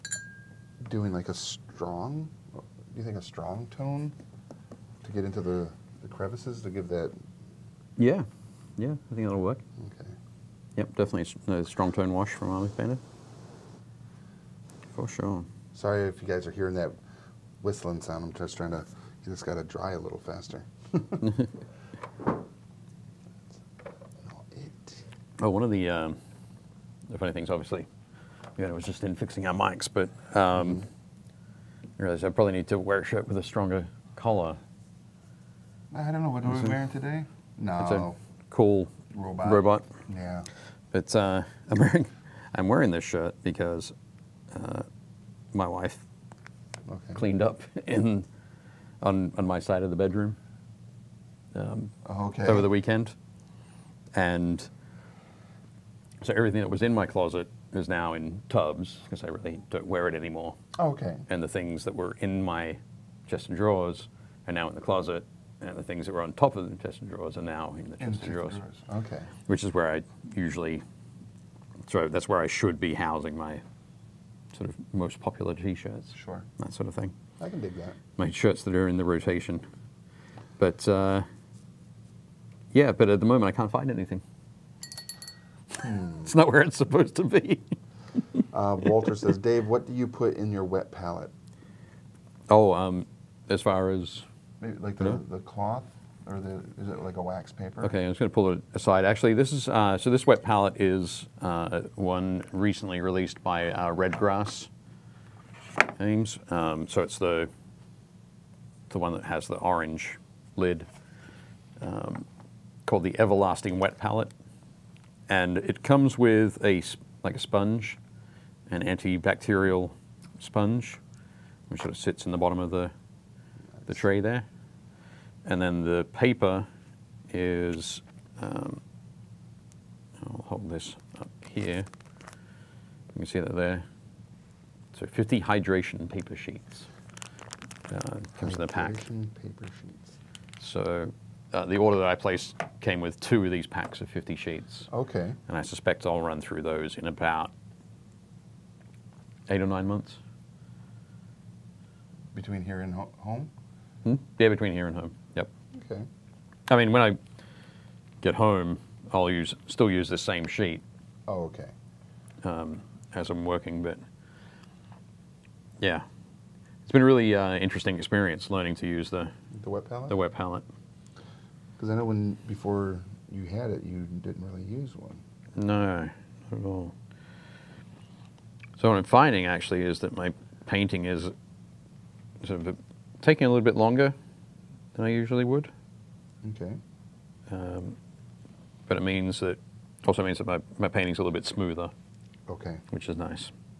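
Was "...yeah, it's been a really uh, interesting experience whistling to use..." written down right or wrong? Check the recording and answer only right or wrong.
wrong.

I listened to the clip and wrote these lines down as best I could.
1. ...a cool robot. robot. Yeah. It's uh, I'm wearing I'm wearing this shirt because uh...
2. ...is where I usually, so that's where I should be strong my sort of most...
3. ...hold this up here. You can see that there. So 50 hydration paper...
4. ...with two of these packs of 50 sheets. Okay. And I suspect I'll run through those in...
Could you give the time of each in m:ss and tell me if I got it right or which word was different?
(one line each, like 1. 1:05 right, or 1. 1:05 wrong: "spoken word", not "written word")
1. 0:37 right
2. 1:09 wrong: "housing", not "strong"
3. 2:10 right
4. 2:23 right.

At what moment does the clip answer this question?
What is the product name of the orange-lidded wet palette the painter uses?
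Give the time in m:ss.
1:53.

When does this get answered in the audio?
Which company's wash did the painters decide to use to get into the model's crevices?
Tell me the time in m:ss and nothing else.
0:12.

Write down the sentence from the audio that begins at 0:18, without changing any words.
I'm just trying to you just got to dry a little faster.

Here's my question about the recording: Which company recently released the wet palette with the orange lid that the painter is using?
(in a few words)
Redgrass Games.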